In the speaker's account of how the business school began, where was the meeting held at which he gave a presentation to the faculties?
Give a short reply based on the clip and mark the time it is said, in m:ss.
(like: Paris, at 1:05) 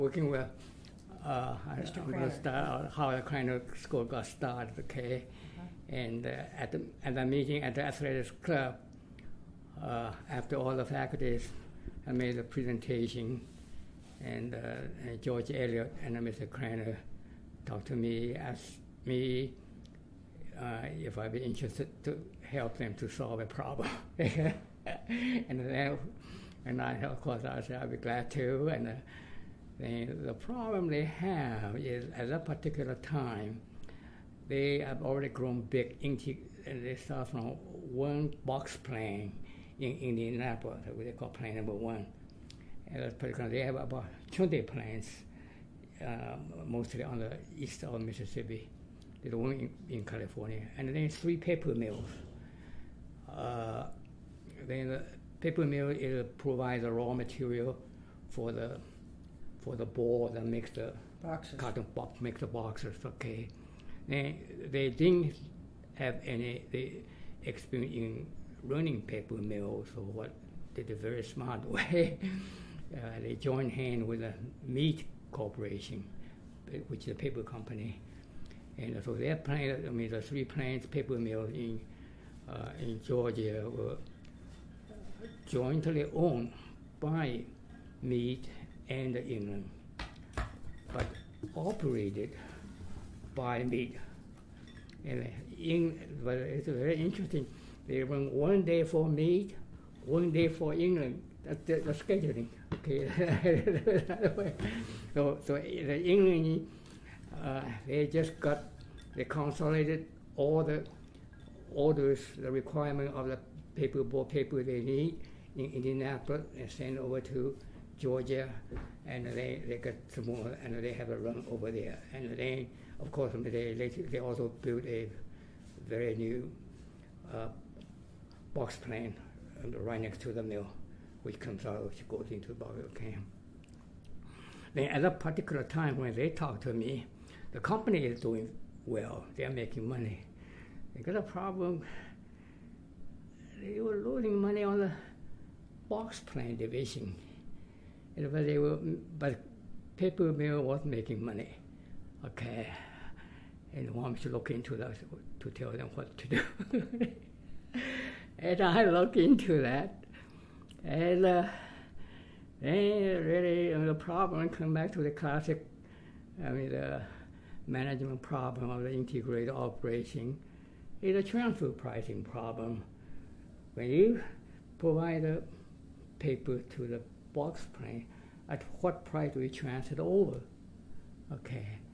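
Athletics Club, at 0:07.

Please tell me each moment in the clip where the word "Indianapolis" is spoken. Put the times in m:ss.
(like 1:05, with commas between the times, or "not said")
0:39, 1:55.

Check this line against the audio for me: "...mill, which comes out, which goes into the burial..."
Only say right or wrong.
right.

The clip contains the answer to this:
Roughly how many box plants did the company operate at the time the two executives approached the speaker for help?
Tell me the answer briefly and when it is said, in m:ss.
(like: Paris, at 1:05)
20, at 0:44.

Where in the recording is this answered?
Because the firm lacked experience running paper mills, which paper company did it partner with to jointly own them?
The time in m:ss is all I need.
1:14.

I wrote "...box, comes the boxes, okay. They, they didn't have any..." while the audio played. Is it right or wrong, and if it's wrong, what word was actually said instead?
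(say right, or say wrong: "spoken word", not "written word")
wrong: "makes", not "comes".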